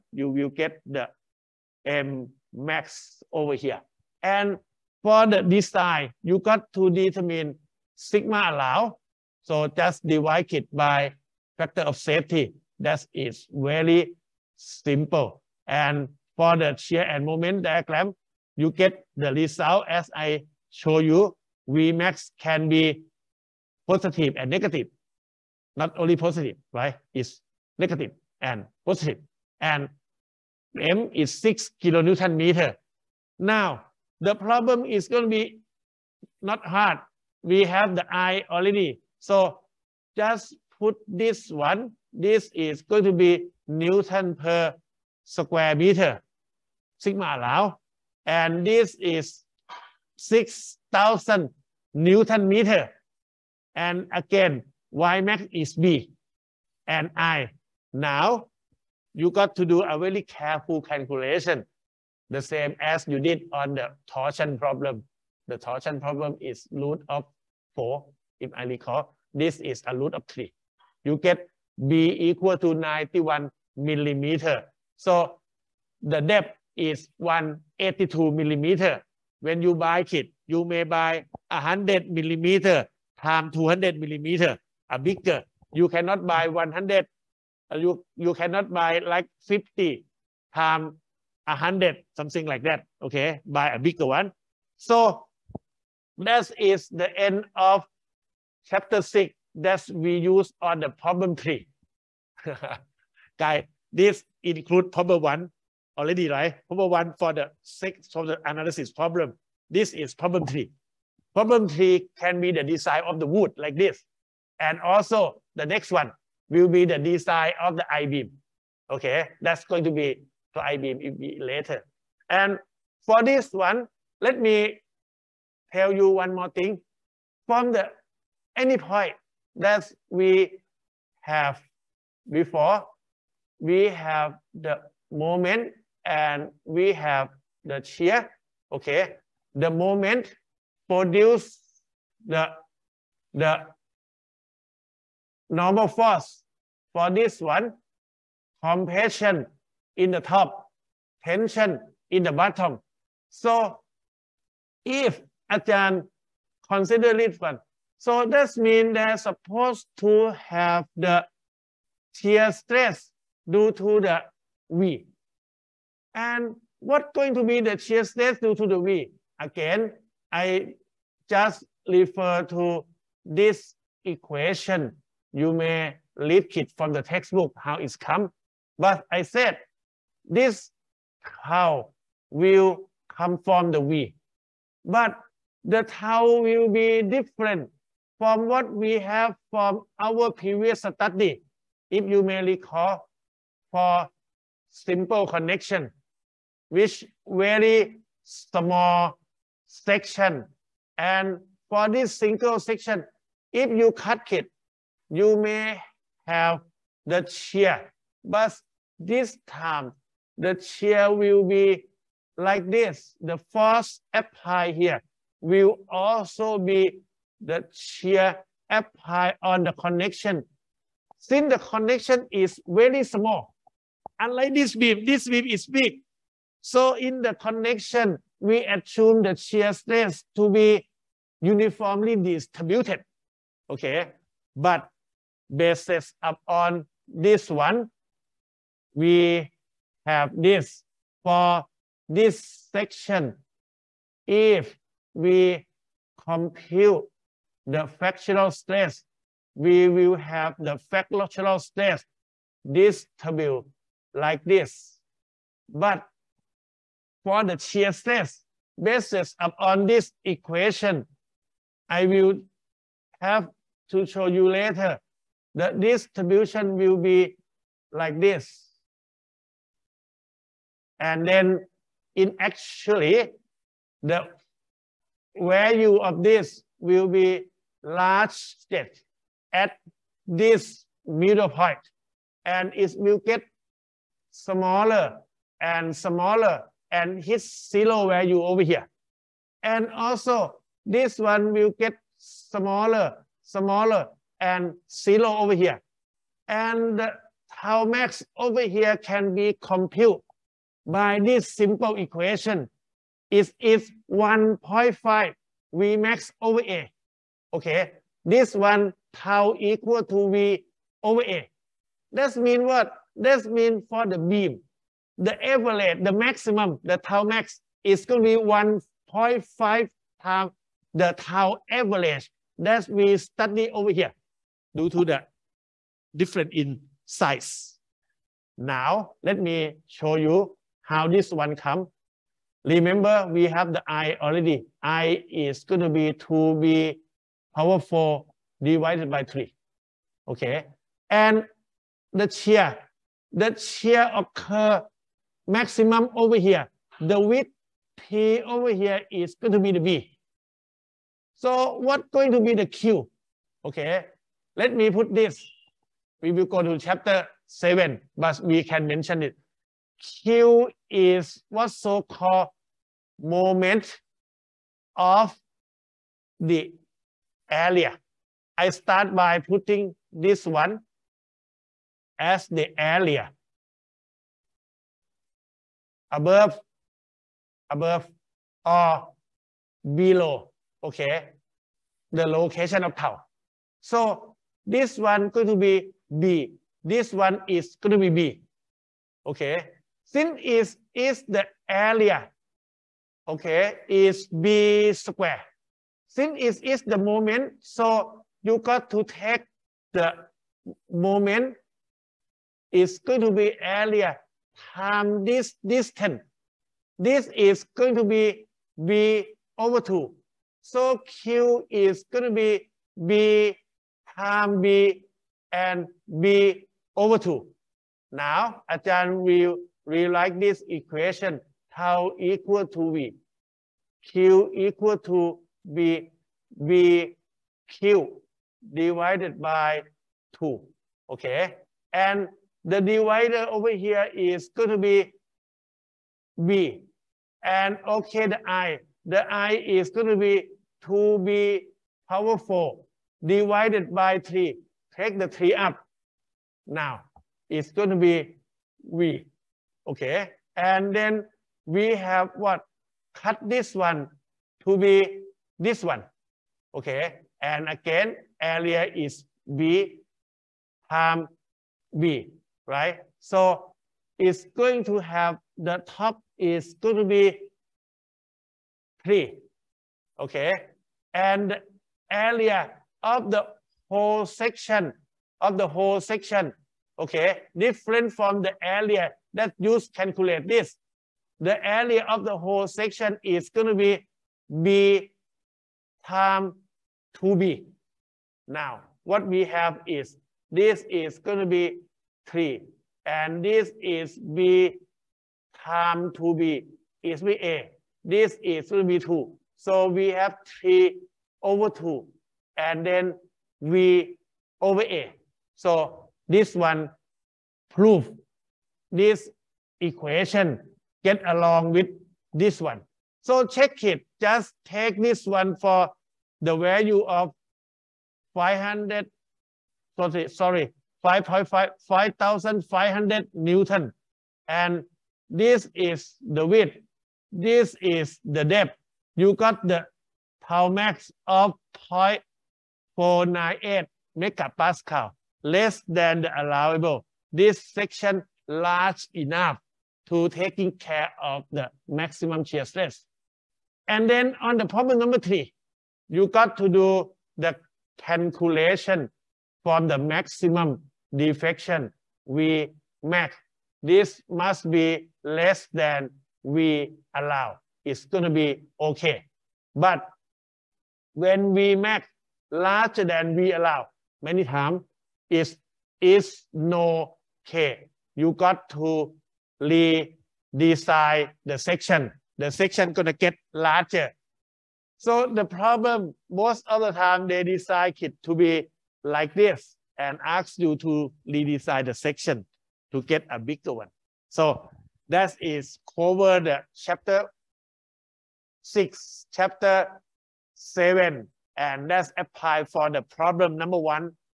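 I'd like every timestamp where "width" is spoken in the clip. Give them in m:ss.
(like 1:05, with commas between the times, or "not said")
5:47, 8:46.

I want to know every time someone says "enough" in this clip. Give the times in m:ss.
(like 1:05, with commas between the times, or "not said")
8:59.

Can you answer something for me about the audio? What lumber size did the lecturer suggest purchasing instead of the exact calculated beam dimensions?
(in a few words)
100 mm by 200 mm.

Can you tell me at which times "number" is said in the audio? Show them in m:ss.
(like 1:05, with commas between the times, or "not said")
9:04, 9:53.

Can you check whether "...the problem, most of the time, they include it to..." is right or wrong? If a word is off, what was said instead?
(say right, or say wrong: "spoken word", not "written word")
wrong: "decide", not "include".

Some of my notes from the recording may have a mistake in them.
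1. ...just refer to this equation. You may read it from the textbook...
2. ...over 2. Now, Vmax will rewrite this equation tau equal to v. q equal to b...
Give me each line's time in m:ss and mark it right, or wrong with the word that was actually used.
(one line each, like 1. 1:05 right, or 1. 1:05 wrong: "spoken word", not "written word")
1. 2:51 right
2. 6:56 wrong: "Ajahn", not "Vmax".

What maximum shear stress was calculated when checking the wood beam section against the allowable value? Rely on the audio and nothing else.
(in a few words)
0.498 MPa.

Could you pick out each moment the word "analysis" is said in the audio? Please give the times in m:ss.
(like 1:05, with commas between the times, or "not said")
1:48.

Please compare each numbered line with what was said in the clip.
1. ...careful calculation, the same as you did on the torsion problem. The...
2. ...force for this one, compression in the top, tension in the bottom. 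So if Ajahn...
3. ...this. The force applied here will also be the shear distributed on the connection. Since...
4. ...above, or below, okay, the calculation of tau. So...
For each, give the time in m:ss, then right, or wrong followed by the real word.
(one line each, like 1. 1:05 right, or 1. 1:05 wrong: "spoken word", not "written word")
1. 1:00 right
2. 2:25 right
3. 3:32 wrong: "applied", not "distributed"
4. 6:17 wrong: "location", not "calculation".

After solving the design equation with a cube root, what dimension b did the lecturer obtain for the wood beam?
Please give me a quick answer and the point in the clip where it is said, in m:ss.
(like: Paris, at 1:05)
91 millimeter, at 1:12.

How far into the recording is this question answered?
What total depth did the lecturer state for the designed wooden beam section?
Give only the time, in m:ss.
1:17.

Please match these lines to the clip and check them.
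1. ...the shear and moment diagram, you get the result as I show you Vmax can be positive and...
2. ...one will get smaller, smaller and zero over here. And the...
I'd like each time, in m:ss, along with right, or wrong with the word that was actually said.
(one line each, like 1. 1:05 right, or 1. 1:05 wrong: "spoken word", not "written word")
1. 0:16 right
2. 4:51 right.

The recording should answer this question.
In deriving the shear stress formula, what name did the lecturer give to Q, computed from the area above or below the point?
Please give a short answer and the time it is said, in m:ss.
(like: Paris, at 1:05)
moment of the area, at 6:03.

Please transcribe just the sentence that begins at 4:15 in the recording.
But for the shear stress basis upon this equation.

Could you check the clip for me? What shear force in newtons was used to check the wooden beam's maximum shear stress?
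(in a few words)
5,500 N.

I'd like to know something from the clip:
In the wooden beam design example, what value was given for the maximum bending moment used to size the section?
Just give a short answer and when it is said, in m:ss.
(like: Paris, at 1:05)
6 kN·m, at 0:31.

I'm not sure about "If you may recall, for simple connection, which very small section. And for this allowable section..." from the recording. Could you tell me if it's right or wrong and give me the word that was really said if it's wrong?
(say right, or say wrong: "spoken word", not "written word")
wrong: "single", not "allowable".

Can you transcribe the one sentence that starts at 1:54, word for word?
And also the next one will be the design of the I-beam.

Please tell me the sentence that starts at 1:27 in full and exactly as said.
You, you cannot buy like 50 times 100, something like that.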